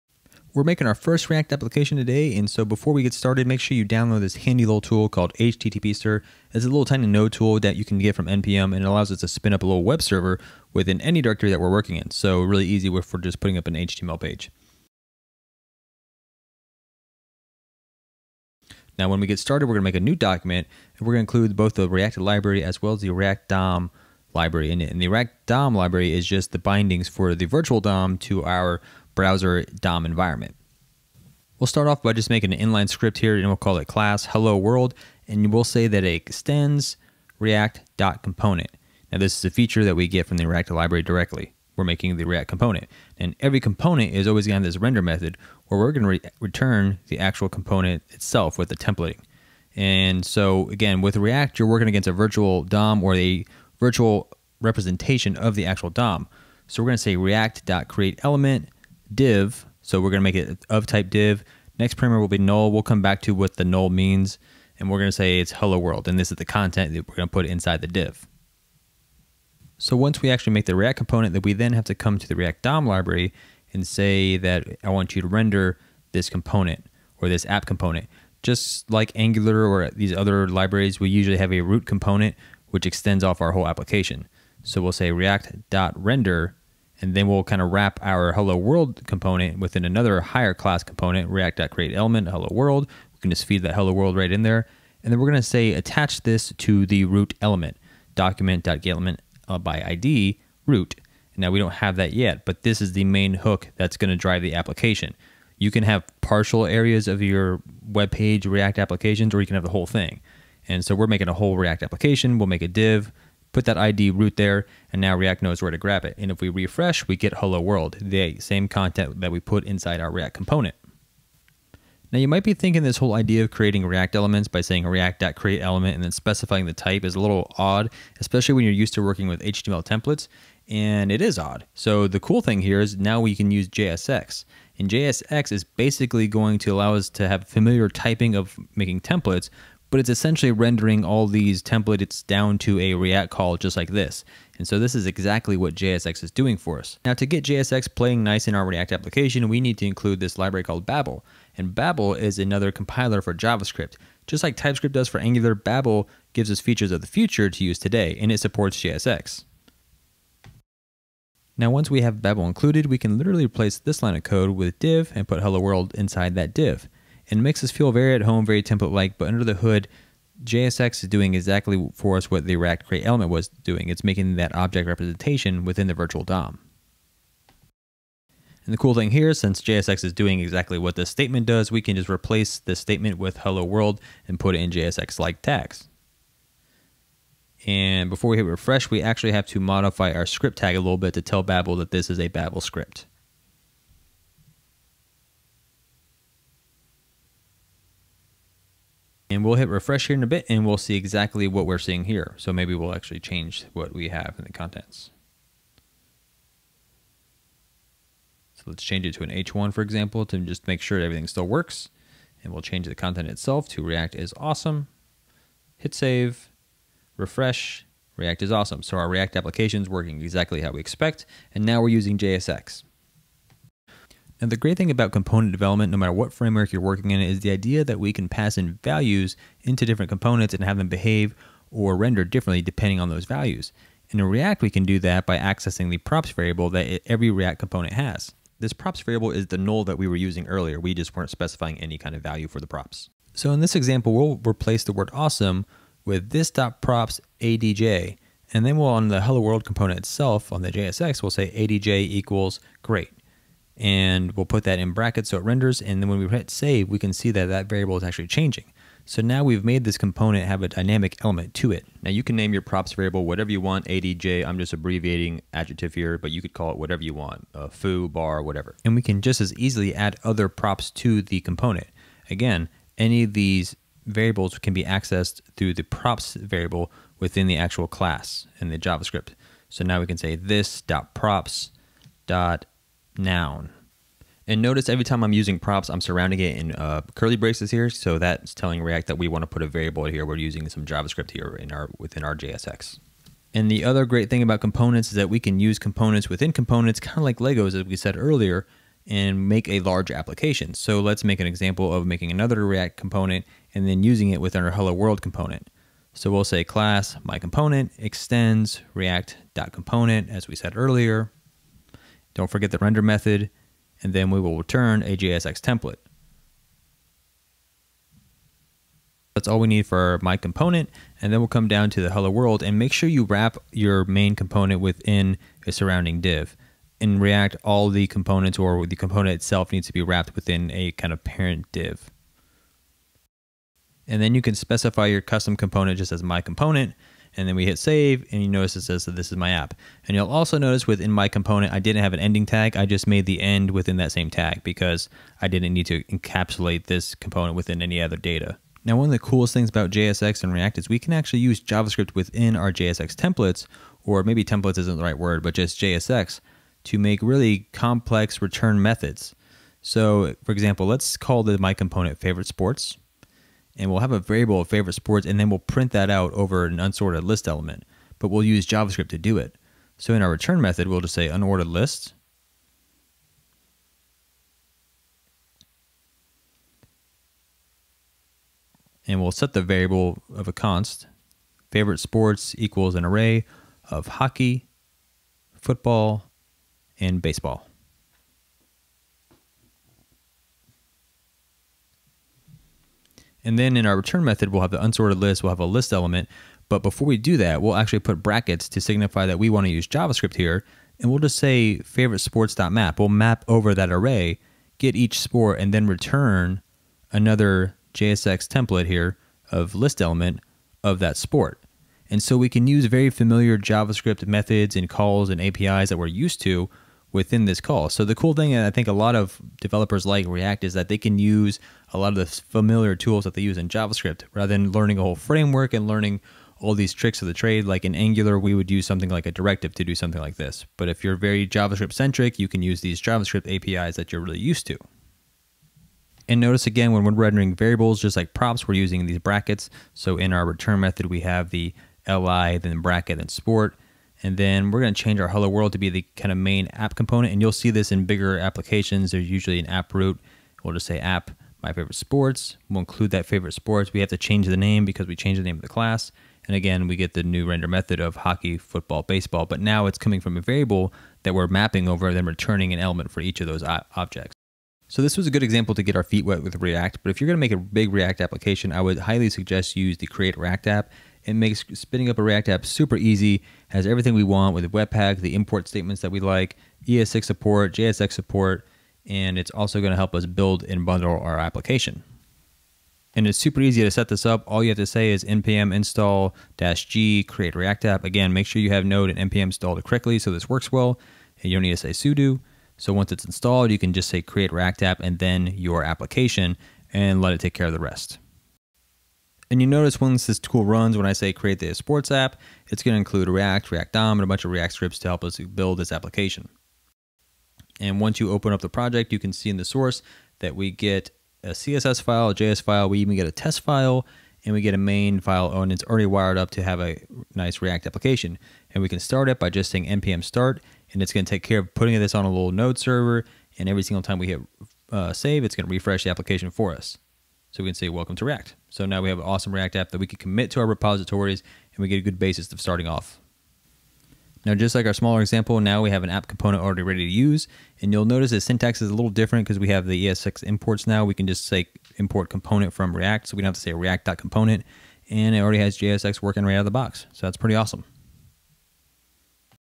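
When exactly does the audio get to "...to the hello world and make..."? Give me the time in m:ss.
5:21.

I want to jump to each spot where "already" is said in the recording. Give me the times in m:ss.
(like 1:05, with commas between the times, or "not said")
8:35, 8:56, 9:05.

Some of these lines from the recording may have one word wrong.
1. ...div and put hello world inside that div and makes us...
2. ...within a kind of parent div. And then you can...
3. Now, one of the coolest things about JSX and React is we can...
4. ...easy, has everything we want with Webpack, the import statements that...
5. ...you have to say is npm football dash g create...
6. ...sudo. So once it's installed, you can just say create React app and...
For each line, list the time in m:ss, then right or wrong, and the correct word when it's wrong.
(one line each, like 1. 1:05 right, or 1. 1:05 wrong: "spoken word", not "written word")
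1. 2:44 right
2. 5:30 right
3. 5:48 right
4. 7:52 right
5. 8:04 wrong: "install", not "football"
6. 8:11 right.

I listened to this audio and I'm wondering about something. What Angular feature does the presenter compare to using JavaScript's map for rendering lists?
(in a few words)
directive.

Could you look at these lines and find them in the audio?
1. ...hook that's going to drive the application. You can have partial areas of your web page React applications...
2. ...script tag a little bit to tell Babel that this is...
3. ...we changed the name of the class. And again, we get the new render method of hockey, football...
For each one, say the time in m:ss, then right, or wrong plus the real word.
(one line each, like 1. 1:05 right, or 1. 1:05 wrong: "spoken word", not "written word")
1. 1:43 right
2. 3:10 right
3. 7:35 right.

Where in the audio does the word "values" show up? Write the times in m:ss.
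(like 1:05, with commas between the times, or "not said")
3:48, 3:53, 4:02.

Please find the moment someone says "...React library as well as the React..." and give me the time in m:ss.
0:21.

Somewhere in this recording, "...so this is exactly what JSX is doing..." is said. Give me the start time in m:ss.
2:24.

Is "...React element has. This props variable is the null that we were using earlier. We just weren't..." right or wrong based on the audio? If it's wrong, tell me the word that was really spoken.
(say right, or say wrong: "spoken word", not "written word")
wrong: "component", not "element".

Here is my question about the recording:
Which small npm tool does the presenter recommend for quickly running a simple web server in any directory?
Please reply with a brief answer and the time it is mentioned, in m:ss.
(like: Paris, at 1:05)
HTTPster, at 0:05.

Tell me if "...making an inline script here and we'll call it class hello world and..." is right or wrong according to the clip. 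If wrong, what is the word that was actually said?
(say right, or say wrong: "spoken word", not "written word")
right.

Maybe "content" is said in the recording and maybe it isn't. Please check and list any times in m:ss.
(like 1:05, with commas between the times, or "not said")
1:06, 1:58, 3:24, 3:32.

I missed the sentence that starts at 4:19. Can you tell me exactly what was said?
So now we've made this component have a dynamic element to it.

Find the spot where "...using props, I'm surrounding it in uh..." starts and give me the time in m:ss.
4:45.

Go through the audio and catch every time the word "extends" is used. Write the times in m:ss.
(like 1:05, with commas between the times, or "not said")
0:36, 1:22, 5:07.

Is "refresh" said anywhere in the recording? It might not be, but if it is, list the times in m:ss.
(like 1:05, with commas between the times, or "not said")
1:56, 3:08, 3:19, 3:37, 8:45.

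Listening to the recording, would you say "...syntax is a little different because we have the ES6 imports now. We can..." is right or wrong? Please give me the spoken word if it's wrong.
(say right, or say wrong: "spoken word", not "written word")
right.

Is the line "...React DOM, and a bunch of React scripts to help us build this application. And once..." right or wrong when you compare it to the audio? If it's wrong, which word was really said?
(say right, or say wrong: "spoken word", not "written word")
right.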